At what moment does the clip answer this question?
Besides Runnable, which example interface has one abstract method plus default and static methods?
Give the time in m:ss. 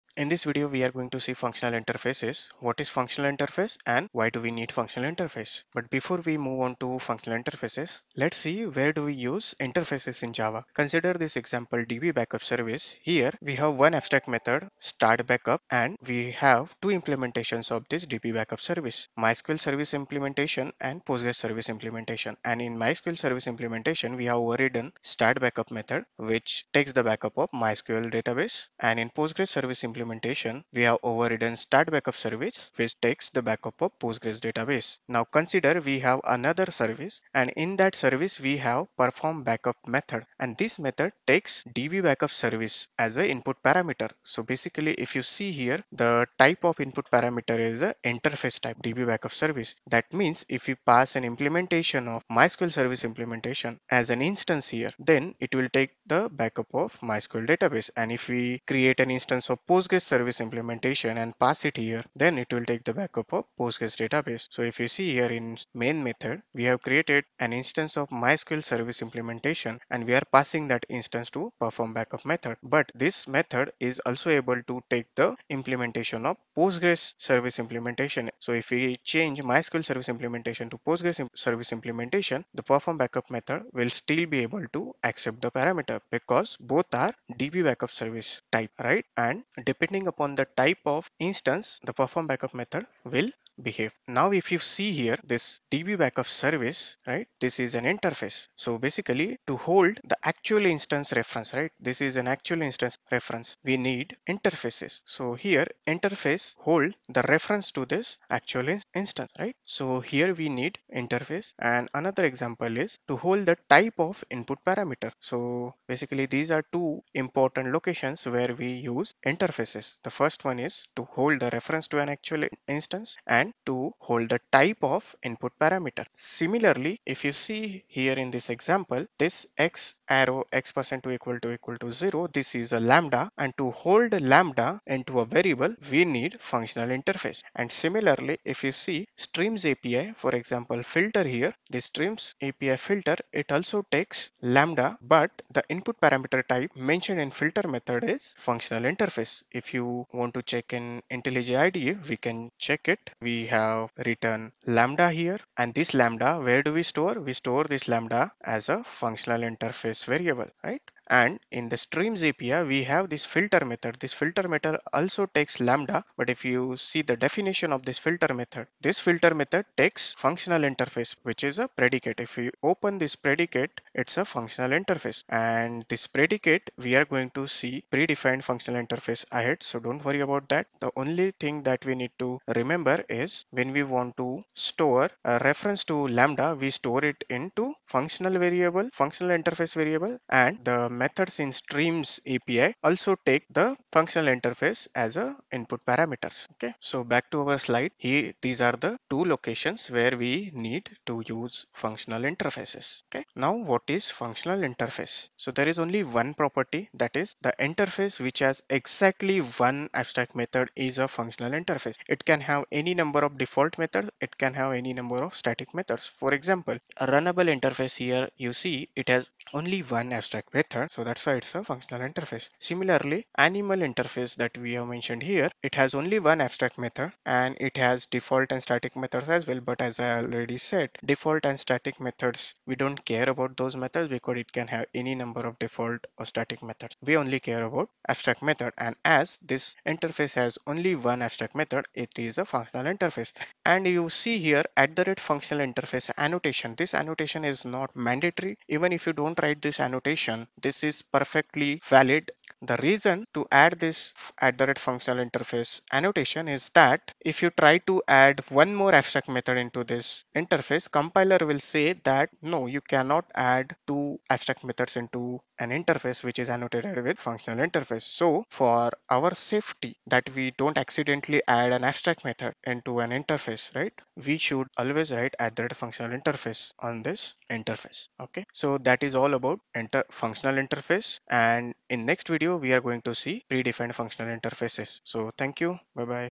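3:43.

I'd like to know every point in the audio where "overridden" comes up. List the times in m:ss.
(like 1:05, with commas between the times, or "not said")
0:24, 0:31.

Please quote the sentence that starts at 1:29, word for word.
And depend depending upon the type of instance, the perform backup method will behave.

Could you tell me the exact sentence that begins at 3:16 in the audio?
Okay, so back to our slide here, these are the two locations where we need to use functional interfaces.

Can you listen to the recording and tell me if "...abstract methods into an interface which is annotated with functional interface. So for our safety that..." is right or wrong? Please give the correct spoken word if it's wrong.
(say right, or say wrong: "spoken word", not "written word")
right.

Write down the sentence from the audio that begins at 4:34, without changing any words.
We should always write at the rate functional interface on this interface.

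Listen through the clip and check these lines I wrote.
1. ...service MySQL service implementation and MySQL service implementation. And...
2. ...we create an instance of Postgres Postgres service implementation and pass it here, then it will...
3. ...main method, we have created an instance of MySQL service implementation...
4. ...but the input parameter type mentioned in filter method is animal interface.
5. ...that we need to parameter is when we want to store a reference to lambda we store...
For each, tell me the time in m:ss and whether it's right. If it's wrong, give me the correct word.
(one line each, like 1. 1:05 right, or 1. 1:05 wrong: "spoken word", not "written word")
1. 0:18 wrong: "Postgres", not "MySQL"
2. 0:58 right
3. 1:05 right
4. 2:25 wrong: "functional", not "animal"
5. 3:01 wrong: "remember", not "parameter".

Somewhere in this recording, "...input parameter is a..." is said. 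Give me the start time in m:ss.
0:46.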